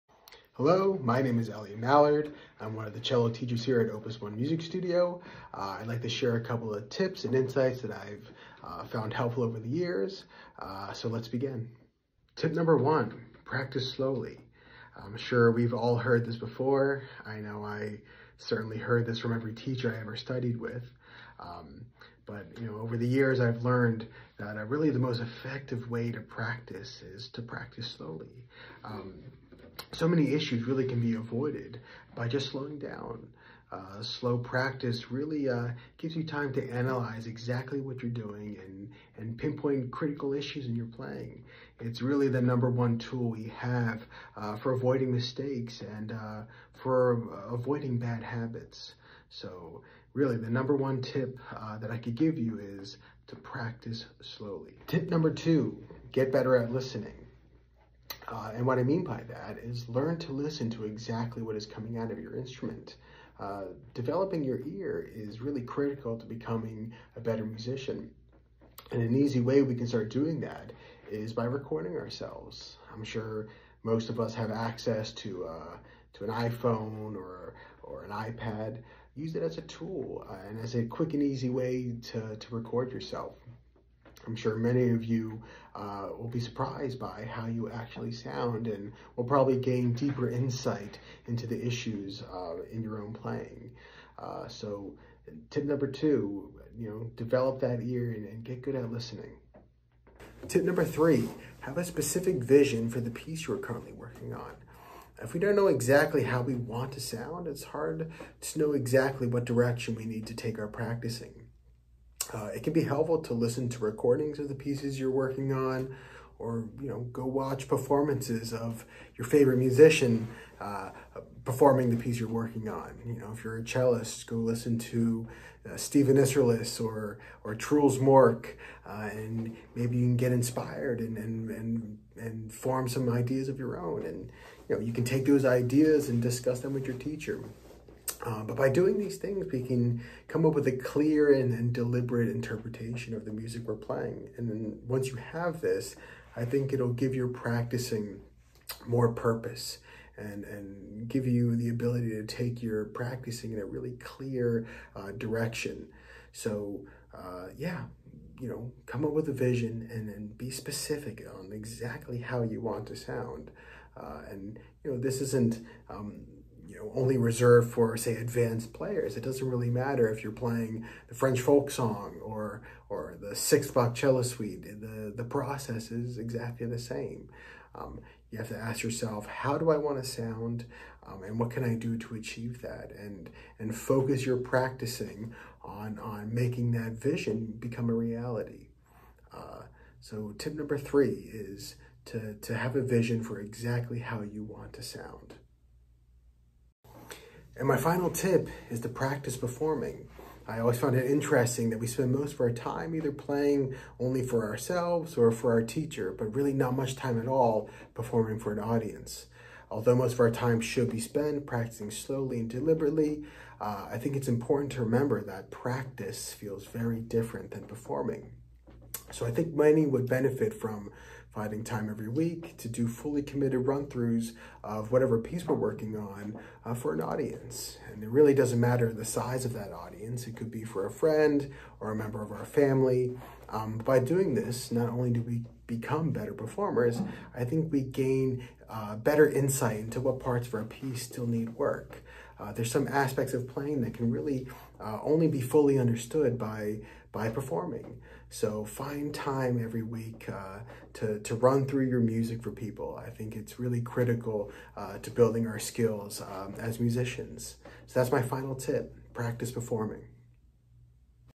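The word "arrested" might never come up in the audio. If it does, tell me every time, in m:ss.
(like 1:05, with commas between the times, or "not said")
not said.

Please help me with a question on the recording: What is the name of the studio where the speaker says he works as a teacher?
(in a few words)
Opus One Music Studio.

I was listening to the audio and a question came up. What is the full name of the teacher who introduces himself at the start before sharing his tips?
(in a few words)
Elliot Mallard.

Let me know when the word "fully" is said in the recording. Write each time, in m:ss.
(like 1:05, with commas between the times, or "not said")
3:42, 4:05.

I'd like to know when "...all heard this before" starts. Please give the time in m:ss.
0:15.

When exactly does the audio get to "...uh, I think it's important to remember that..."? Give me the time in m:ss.
3:33.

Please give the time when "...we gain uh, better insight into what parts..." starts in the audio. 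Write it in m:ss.
3:57.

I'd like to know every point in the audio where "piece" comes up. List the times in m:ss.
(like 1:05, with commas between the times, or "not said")
1:43, 1:54, 2:01, 3:45, 4:00.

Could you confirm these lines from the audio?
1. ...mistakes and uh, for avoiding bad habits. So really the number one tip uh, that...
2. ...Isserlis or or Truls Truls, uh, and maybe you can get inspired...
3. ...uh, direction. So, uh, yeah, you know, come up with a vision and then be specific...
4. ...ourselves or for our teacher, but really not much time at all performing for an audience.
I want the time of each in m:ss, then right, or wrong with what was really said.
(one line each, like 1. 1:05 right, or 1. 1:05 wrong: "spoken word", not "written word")
1. 0:45 right
2. 2:06 wrong: "Mork", not "Truls"
3. 2:34 right
4. 3:24 right.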